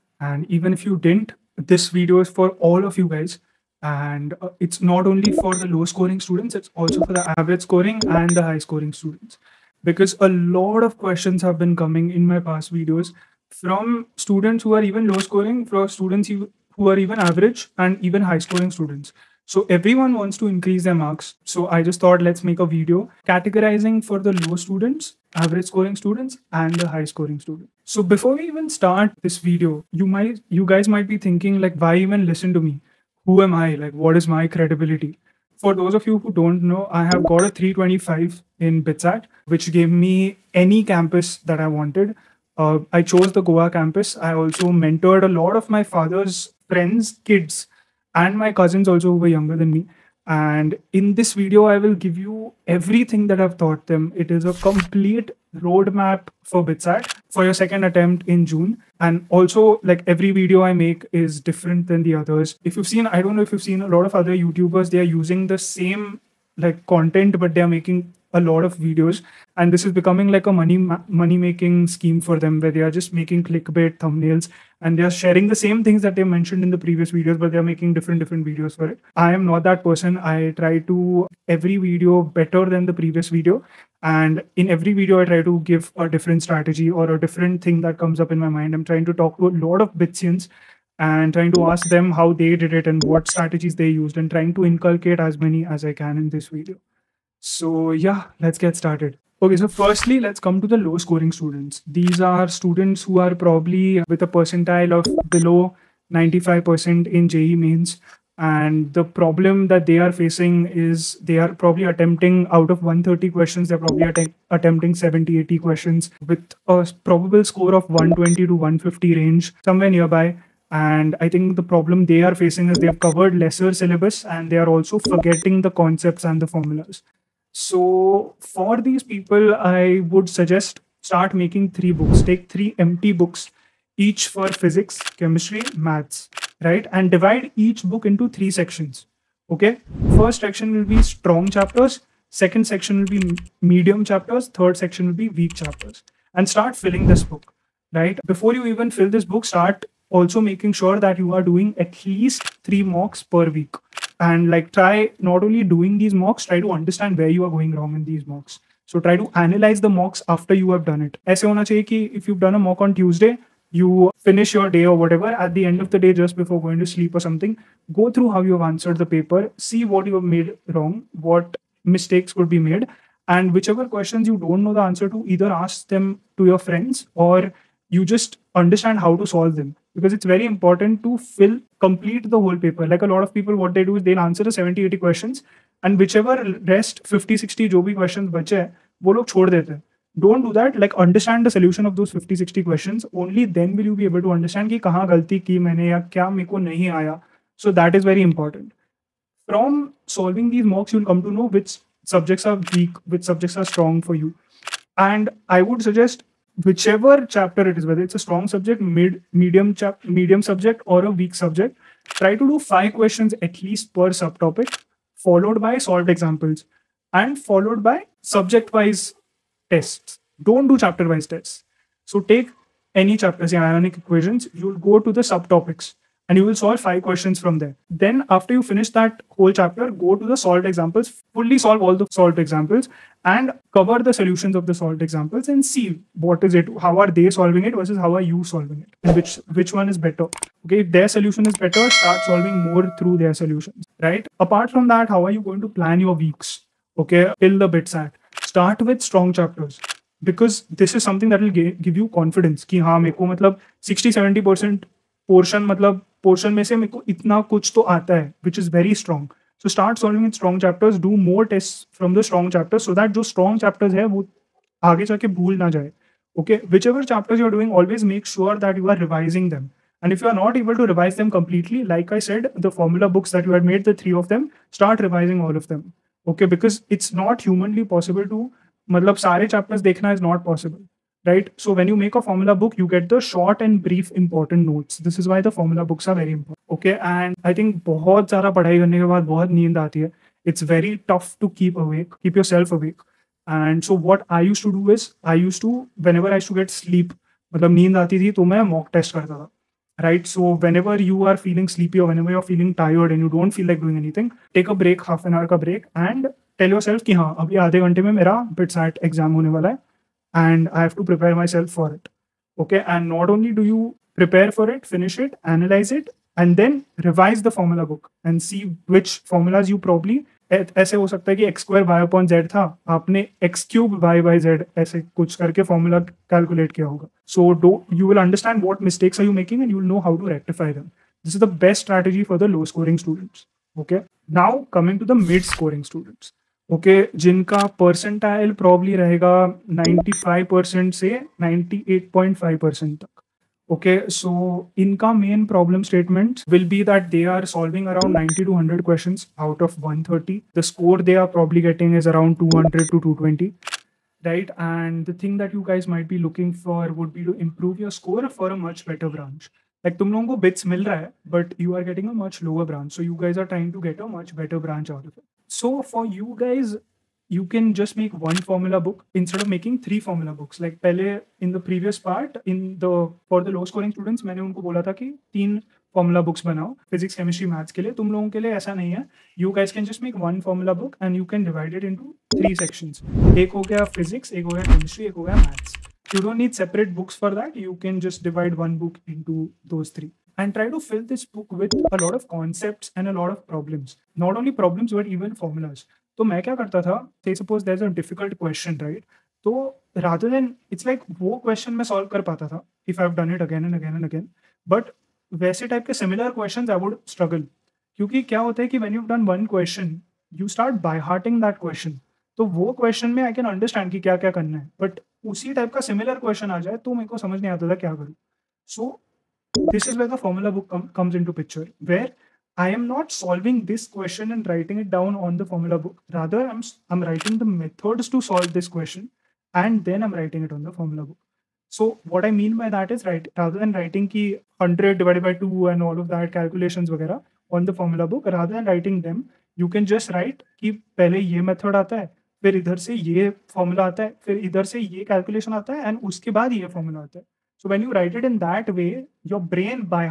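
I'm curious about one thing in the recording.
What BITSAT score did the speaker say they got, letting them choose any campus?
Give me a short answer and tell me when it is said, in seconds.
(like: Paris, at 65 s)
325, at 37 s.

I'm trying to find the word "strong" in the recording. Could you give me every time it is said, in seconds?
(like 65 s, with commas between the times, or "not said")
141 s, 203 s, 208 s, 249 s.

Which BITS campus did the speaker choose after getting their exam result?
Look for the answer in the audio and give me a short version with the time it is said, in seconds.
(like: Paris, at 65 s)
Goa, at 43 s.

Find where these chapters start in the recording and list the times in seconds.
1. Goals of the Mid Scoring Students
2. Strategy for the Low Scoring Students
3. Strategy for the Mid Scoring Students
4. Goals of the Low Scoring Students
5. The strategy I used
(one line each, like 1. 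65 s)
1. 333 s
2. 133 s
3. 363 s
4. 98 s
5. 283 s.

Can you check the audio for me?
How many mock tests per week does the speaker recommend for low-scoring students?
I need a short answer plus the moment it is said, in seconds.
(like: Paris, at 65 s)
3, at 152 s.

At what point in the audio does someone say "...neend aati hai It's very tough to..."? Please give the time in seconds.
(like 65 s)
289 s.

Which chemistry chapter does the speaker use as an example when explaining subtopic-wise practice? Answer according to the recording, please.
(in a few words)
Ionic equations.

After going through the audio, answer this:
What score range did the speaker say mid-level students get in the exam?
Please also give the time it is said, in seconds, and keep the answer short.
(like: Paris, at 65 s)
200 to 220, at 352 s.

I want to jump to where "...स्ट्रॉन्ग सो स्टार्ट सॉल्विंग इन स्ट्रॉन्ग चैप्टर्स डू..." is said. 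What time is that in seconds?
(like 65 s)
258 s.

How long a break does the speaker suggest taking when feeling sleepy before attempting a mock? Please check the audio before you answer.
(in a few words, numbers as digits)
Half an hour.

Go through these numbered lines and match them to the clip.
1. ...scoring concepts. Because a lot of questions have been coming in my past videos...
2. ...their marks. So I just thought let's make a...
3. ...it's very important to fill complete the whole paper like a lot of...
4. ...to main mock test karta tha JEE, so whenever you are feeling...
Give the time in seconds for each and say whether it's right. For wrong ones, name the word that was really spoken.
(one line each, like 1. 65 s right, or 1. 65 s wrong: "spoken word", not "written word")
1. 8 s wrong: "students", not "concepts"
2. 20 s right
3. 180 s right
4. 298 s wrong: "Right", not "JEE".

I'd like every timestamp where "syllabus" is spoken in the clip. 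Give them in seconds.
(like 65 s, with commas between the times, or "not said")
123 s.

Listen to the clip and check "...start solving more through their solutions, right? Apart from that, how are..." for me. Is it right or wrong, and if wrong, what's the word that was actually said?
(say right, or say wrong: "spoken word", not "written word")
right.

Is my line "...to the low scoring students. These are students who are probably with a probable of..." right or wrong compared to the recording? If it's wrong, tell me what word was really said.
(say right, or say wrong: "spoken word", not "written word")
wrong: "percentile", not "probable".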